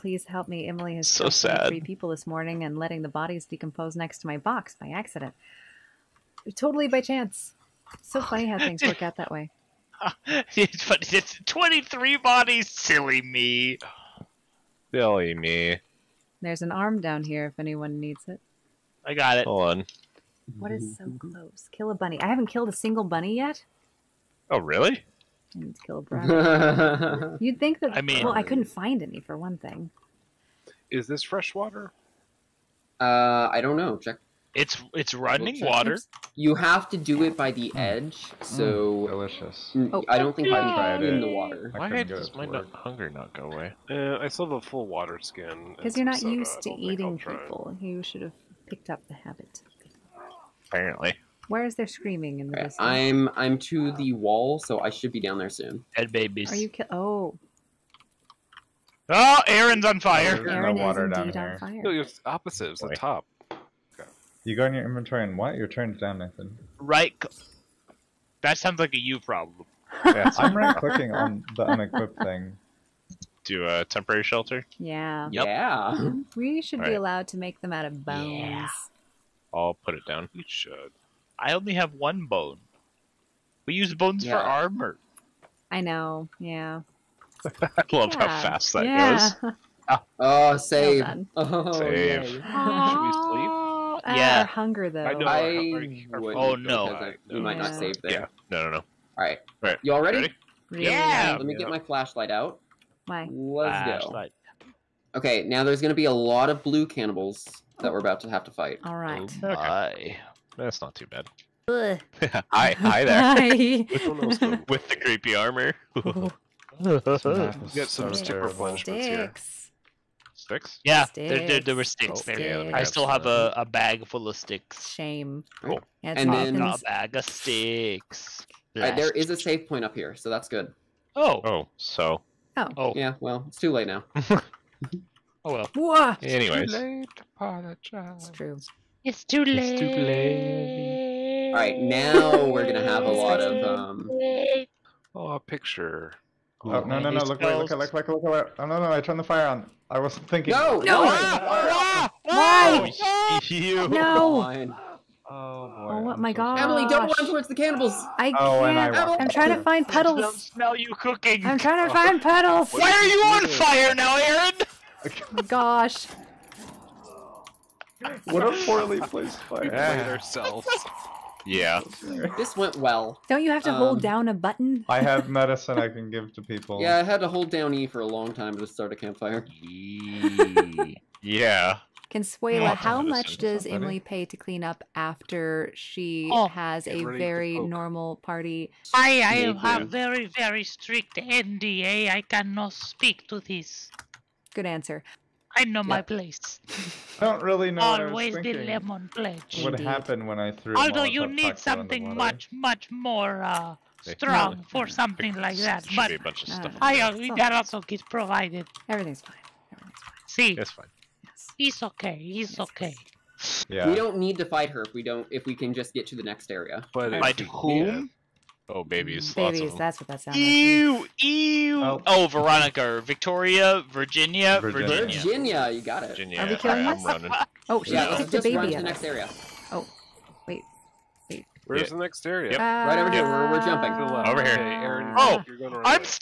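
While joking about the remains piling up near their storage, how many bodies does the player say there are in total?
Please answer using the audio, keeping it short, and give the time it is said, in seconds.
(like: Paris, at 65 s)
23, at 11 s.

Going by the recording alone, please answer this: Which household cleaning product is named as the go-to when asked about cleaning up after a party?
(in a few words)
lemon pledge.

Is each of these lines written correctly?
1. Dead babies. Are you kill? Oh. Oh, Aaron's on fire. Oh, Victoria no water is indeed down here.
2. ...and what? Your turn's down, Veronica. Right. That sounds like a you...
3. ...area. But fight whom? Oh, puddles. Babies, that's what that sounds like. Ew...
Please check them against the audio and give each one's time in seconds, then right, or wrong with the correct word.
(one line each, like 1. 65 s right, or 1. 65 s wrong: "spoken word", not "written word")
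1. 55 s wrong: "Aaron", not "Victoria"
2. 65 s wrong: "Nathan", not "Veronica"
3. 216 s wrong: "babies", not "puddles".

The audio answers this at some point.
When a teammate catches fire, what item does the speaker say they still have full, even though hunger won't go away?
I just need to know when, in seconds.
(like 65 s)
44 s.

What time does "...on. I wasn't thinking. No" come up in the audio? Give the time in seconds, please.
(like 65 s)
149 s.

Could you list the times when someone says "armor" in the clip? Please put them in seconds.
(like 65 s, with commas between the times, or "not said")
84 s, 115 s.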